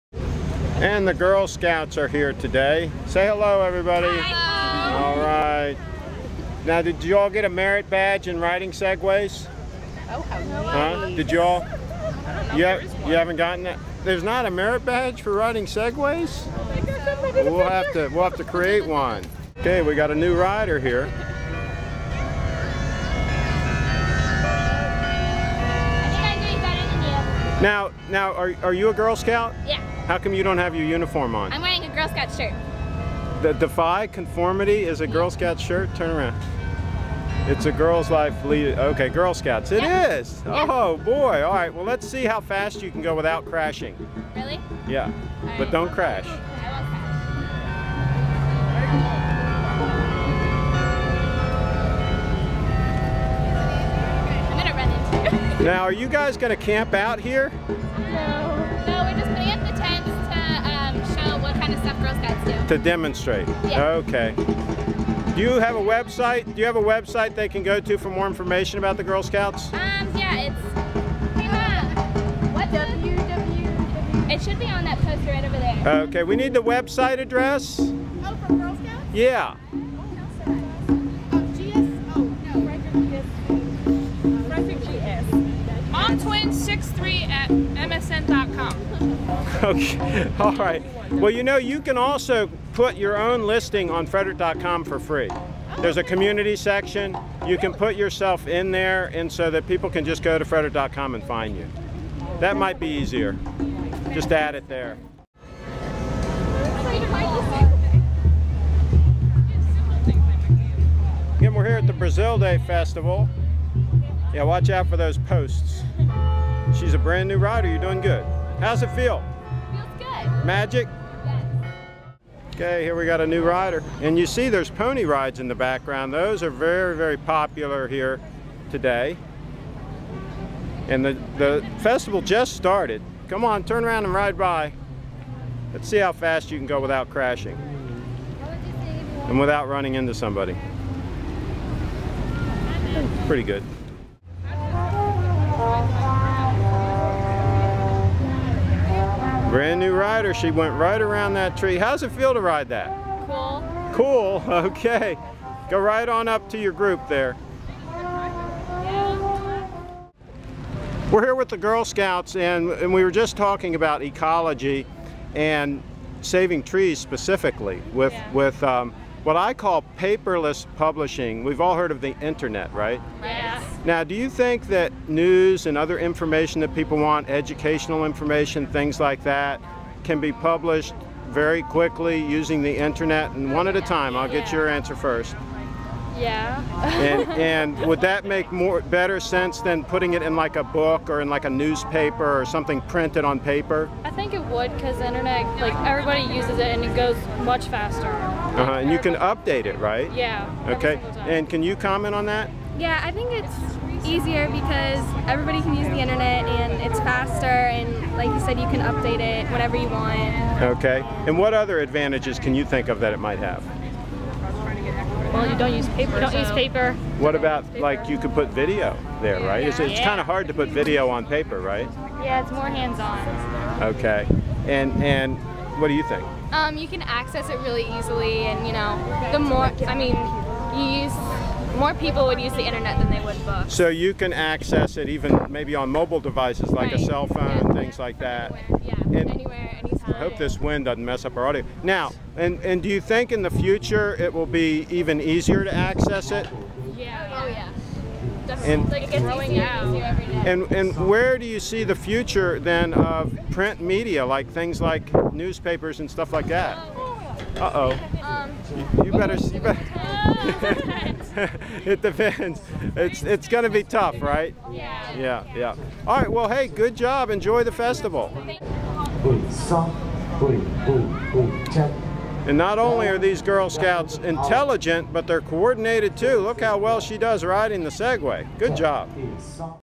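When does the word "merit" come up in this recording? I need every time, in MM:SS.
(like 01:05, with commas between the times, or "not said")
00:07, 00:14.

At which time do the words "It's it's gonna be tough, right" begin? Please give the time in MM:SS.
04:22.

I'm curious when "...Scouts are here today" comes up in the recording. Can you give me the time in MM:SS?
00:01.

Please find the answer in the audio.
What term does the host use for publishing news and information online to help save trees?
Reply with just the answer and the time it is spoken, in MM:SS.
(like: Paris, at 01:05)
paperless publishing, at 02:49.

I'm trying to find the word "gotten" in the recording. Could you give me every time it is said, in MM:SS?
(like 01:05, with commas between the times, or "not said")
00:13.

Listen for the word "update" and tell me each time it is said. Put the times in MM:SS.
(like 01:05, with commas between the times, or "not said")
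03:19, 03:28.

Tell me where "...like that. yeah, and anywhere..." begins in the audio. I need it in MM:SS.
03:57.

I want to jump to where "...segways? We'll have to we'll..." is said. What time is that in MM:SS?
00:15.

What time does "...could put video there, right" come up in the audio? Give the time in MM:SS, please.
03:38.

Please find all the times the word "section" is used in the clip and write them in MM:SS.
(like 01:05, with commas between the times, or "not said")
01:36.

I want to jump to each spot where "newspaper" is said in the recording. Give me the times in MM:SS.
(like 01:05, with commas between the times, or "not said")
03:11, 04:15.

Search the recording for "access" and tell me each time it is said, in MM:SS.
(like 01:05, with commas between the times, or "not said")
03:47, 03:54, 04:05.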